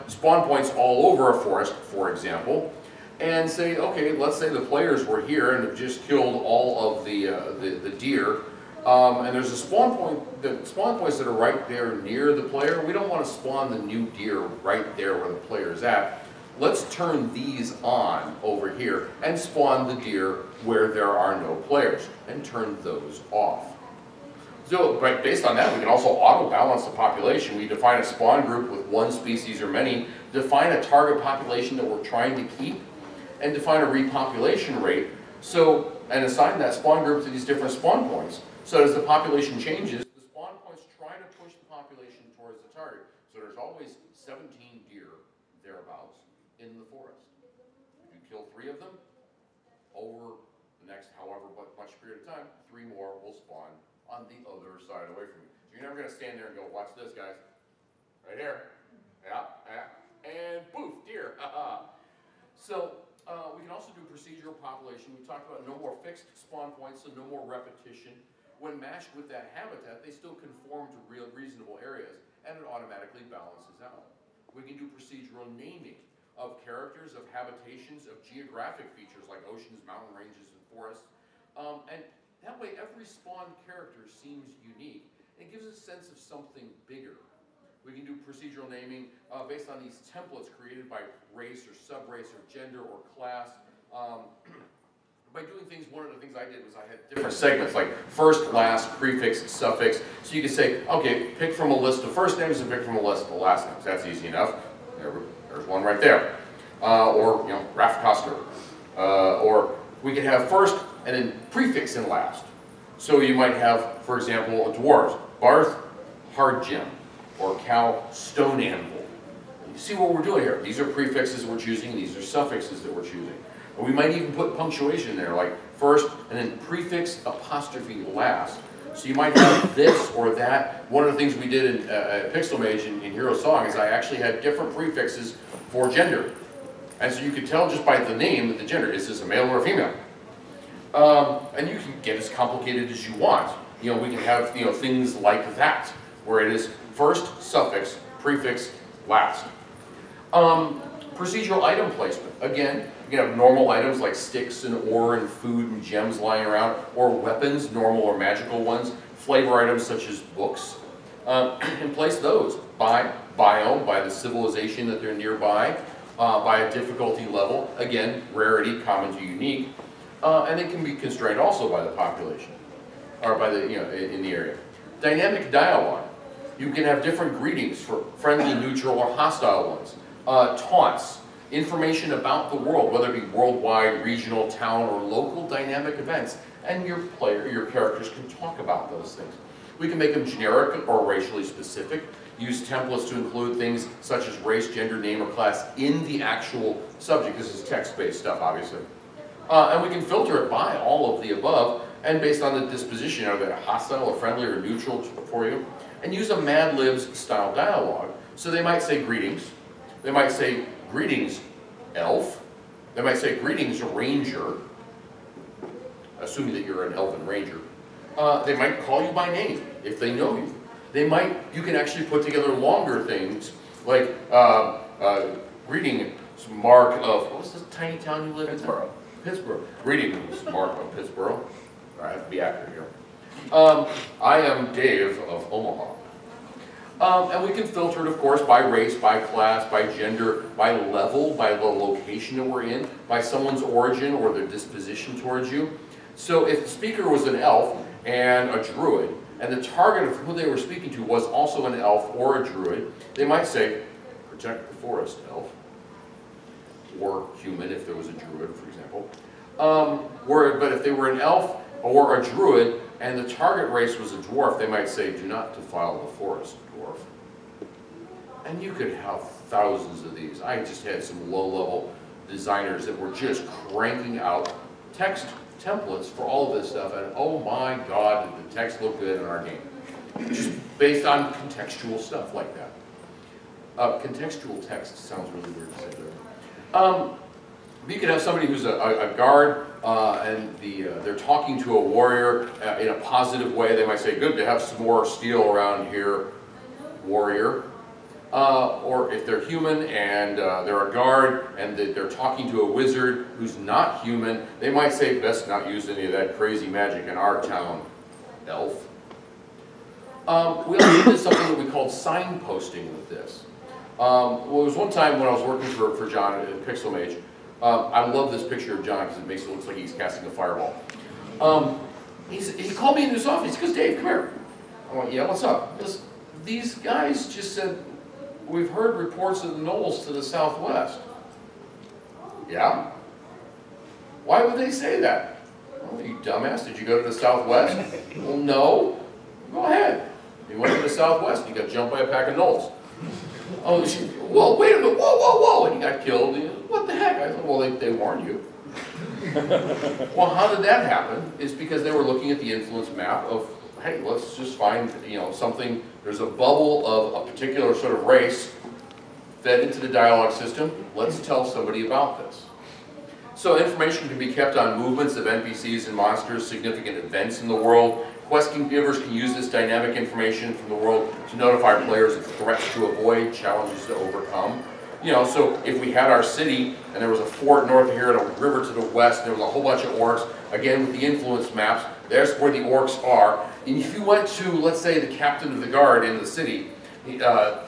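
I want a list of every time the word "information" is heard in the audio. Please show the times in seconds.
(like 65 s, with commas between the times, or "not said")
181 s, 363 s, 369 s.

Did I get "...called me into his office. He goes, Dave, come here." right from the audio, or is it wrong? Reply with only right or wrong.
right.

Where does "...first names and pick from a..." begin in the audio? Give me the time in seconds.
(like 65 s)
102 s.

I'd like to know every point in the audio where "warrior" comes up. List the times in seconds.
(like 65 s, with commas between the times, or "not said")
291 s, 297 s.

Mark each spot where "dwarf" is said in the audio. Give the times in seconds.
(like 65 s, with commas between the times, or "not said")
114 s, 264 s.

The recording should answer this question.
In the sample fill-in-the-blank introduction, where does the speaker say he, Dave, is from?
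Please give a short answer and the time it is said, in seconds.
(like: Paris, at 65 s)
Omaha, at 235 s.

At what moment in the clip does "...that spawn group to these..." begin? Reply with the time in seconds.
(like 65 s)
36 s.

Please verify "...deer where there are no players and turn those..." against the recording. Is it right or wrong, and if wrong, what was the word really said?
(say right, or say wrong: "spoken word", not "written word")
right.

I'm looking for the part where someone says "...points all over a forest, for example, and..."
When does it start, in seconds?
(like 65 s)
0 s.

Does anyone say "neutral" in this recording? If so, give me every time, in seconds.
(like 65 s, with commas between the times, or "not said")
178 s, 204 s.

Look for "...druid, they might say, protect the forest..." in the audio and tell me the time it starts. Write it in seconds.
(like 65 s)
252 s.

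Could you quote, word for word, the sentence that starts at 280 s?
Just based on contextual stuff like that.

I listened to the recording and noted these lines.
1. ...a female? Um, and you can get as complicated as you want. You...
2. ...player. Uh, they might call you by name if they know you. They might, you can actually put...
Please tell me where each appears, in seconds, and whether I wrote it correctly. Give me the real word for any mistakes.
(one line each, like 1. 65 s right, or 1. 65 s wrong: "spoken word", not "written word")
1. 139 s right
2. 217 s wrong: "ranger", not "player".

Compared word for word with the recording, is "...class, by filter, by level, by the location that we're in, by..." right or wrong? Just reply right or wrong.
wrong.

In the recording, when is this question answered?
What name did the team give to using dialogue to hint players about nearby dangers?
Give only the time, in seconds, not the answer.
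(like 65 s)
311 s.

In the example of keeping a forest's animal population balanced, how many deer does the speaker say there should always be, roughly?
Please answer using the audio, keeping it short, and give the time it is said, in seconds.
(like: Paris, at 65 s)
17, at 44 s.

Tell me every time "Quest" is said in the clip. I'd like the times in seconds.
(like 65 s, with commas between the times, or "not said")
368 s.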